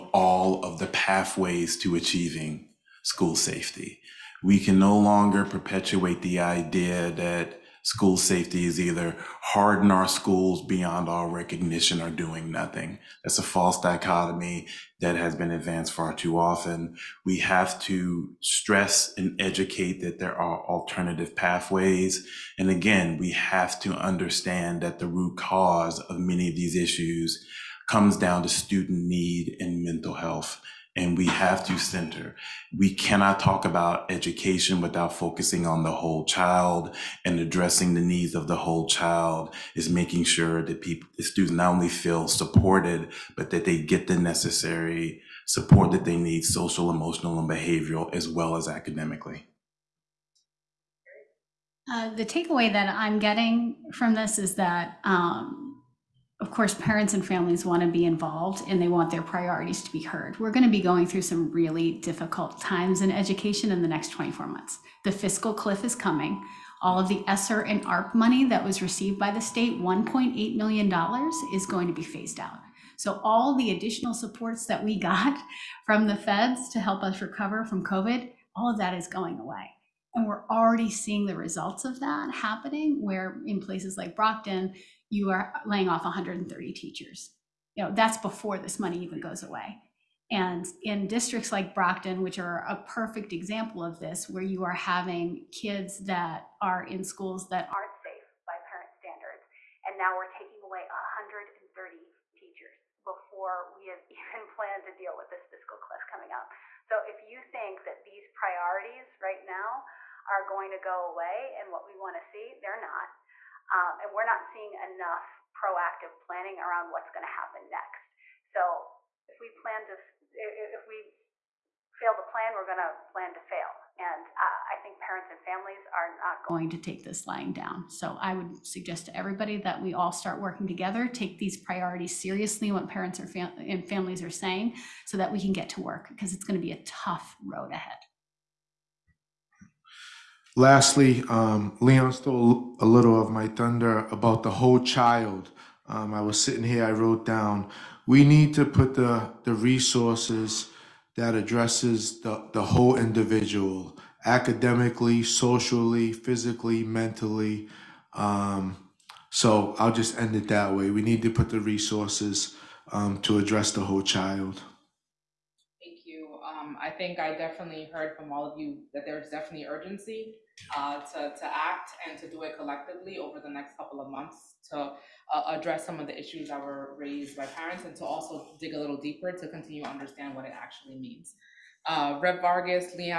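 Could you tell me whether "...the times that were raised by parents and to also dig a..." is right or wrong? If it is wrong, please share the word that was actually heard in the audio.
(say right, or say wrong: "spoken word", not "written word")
wrong: "issues", not "times".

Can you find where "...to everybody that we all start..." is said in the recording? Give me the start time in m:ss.
2:09.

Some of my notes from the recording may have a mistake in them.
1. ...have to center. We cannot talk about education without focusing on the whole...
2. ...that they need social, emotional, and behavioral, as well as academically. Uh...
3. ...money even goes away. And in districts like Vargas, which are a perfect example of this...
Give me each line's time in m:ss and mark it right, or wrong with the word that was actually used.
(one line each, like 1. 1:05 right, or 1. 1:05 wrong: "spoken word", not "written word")
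1. 0:31 right
2. 0:45 right
3. 1:28 wrong: "Brockton", not "Vargas".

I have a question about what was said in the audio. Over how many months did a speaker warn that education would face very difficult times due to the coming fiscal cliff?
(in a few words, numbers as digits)
24 months.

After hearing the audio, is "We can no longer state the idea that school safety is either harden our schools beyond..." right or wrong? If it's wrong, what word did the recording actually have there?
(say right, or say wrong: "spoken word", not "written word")
wrong: "perpetuate", not "state".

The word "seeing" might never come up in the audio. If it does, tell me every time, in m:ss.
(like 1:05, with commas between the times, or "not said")
1:20, 1:54.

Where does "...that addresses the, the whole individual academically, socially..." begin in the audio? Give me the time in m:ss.
2:31.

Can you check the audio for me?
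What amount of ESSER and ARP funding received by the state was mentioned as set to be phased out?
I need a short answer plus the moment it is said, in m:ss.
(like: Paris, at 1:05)
$1.8 million, at 1:09.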